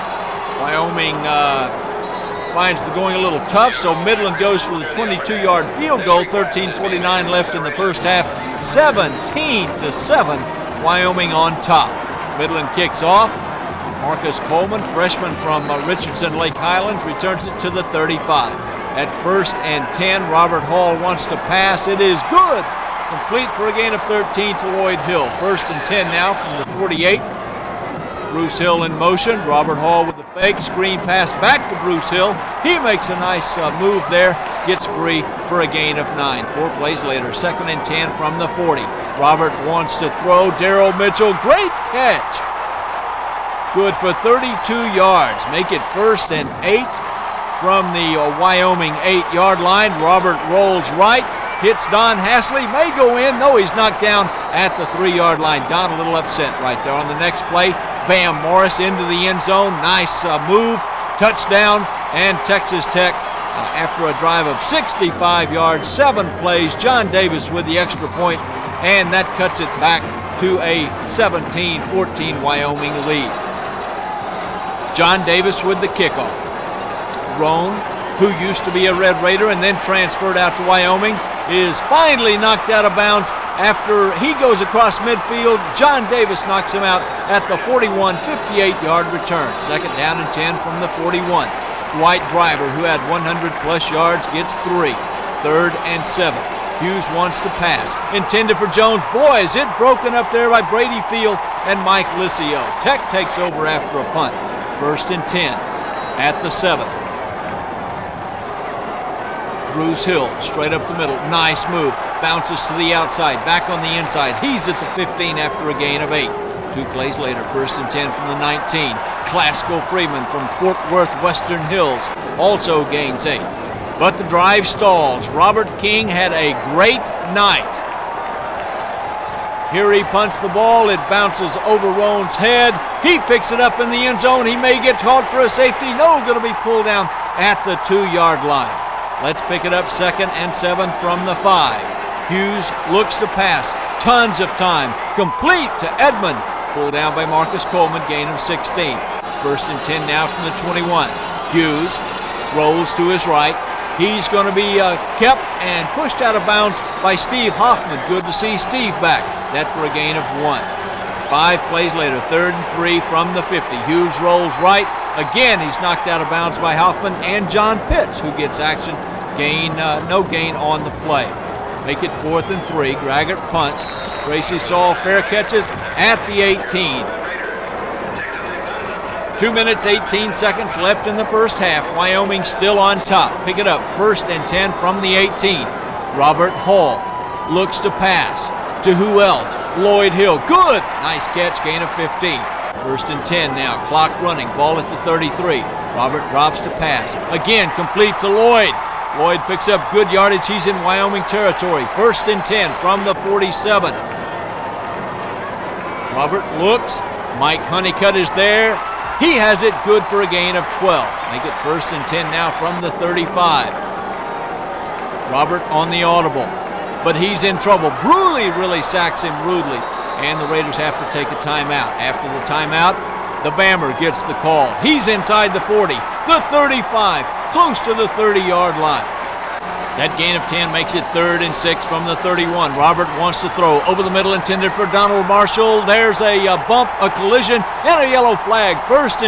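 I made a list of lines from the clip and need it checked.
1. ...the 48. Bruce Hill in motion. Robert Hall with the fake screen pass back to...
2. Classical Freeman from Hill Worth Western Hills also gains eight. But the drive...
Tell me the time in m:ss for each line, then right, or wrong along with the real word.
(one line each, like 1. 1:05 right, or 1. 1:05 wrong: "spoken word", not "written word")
1. 0:26 right
2. 1:59 wrong: "Fort", not "Hill".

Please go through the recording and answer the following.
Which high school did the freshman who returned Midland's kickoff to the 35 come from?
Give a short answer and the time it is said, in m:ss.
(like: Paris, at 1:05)
Richardson Lake Highlands, at 0:15.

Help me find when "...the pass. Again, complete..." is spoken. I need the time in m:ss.
3:16.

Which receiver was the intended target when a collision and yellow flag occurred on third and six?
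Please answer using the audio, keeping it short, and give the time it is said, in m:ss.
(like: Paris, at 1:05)
Donald Marshall, at 3:54.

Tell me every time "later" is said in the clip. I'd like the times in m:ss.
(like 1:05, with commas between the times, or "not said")
0:37, 1:57, 2:41.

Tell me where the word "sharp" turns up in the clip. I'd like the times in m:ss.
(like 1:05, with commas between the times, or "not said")
not said.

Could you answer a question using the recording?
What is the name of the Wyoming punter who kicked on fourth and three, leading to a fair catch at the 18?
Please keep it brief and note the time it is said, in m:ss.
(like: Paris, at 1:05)
Graggart, at 2:53.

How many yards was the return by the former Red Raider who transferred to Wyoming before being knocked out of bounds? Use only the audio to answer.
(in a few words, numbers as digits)
58.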